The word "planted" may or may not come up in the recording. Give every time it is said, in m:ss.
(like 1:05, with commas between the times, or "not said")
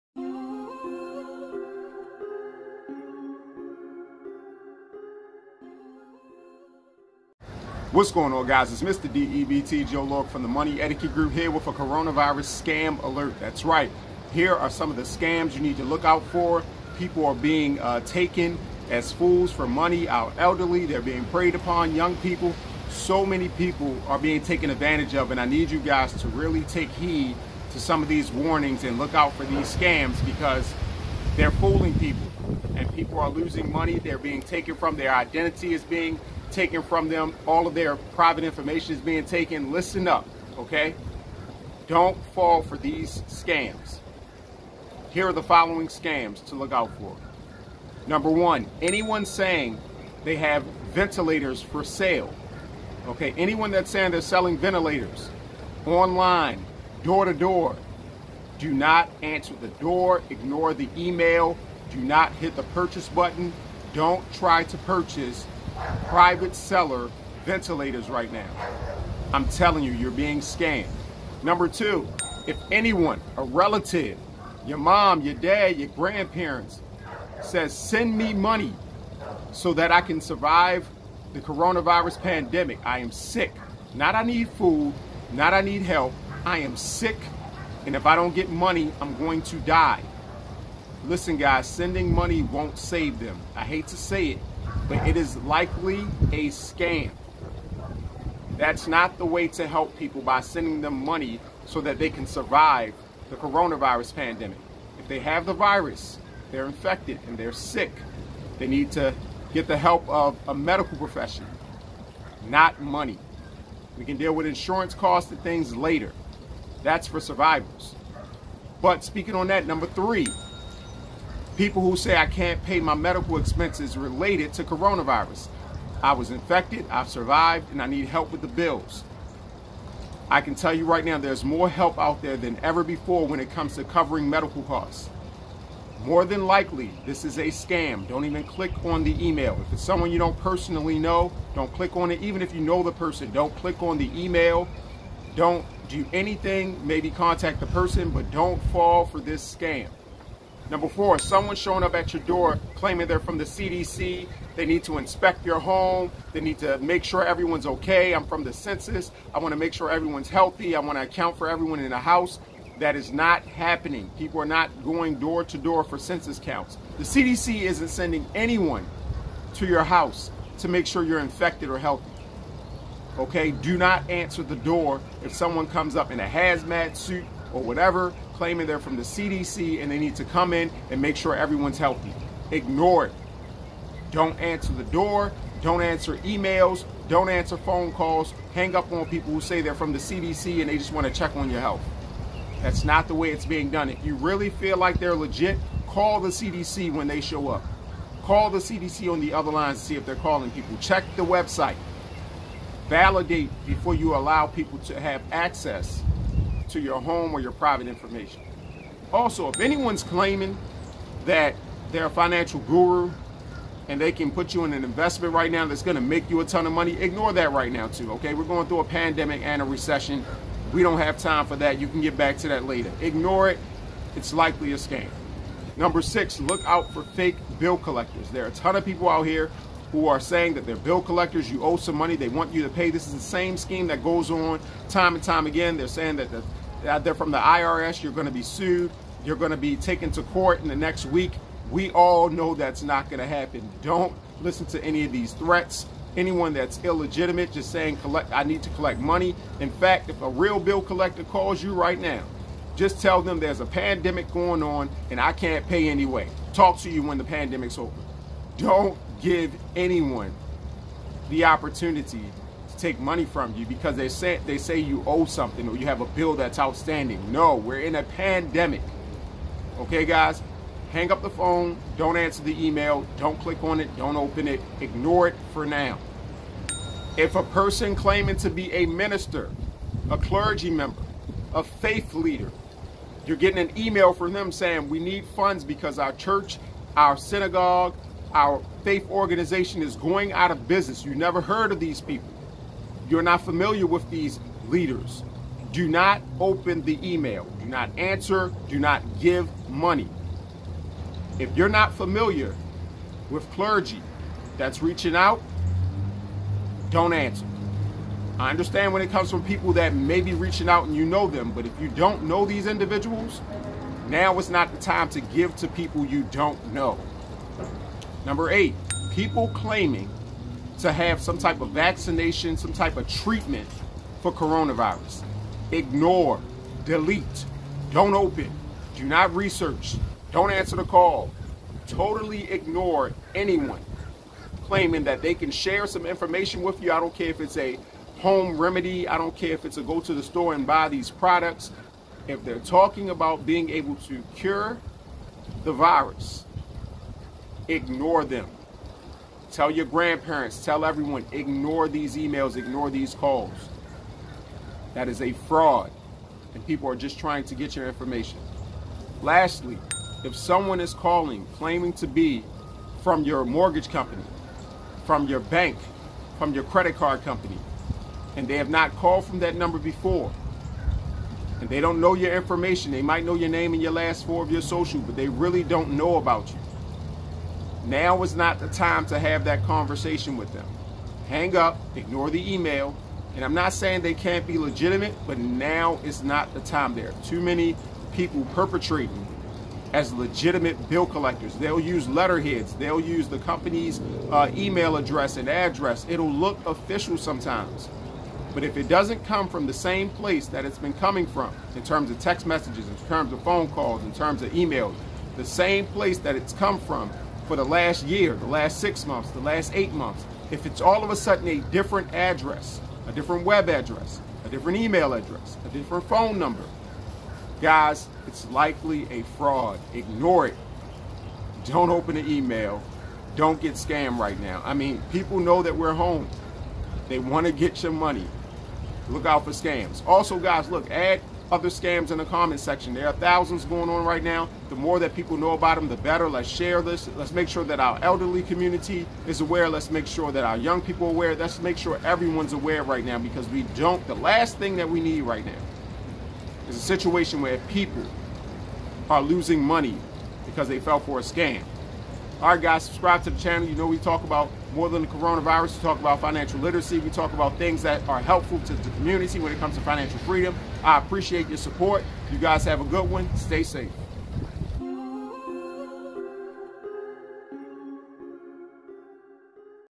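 not said.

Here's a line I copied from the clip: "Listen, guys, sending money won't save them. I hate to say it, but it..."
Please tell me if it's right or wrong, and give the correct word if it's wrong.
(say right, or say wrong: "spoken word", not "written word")
right.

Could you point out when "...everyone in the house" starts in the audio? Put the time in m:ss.
2:41.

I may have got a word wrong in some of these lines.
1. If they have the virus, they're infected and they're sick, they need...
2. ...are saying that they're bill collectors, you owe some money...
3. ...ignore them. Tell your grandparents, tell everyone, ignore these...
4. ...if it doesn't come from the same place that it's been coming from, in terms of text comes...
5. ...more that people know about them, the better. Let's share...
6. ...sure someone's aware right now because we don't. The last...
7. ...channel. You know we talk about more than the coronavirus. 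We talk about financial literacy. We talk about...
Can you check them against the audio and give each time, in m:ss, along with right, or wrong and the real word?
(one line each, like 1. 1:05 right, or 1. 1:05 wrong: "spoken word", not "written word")
1. 1:44 right
2. 3:50 right
3. 5:47 right
4. 6:38 wrong: "messages", not "comes"
5. 7:14 right
6. 7:21 wrong: "everyone", not "someone"
7. 7:33 right.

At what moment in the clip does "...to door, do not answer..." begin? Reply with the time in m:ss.
0:57.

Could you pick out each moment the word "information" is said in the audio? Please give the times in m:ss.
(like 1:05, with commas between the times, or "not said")
0:38, 3:27, 5:36, 5:57, 6:12.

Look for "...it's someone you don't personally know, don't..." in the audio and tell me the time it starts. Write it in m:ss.
2:19.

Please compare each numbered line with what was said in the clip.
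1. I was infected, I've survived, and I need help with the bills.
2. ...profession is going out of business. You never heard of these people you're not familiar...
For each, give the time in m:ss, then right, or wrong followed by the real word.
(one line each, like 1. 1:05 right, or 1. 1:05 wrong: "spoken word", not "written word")
1. 2:06 right
2. 4:49 wrong: "organization", not "profession".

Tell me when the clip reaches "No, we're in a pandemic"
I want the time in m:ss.
4:27.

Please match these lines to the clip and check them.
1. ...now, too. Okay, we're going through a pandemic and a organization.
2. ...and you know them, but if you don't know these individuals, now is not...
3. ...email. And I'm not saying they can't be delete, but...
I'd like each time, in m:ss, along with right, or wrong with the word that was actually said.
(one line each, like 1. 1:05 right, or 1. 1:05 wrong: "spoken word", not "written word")
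1. 3:37 wrong: "recession", not "organization"
2. 5:10 right
3. 6:22 wrong: "legitimate", not "delete".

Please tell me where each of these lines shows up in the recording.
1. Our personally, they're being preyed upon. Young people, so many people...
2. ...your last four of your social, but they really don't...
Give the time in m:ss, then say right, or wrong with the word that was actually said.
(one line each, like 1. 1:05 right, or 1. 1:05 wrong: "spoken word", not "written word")
1. 0:20 wrong: "elderly", not "personally"
2. 6:13 right.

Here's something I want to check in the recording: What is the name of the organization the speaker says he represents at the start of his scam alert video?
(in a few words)
Money Etiquette Group.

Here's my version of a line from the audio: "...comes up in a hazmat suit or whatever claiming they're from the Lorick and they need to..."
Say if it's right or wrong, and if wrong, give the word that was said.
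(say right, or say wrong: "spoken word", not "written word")
wrong: "CDC", not "Lorick".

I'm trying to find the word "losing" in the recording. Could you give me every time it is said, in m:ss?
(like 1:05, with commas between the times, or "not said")
0:33, 7:29.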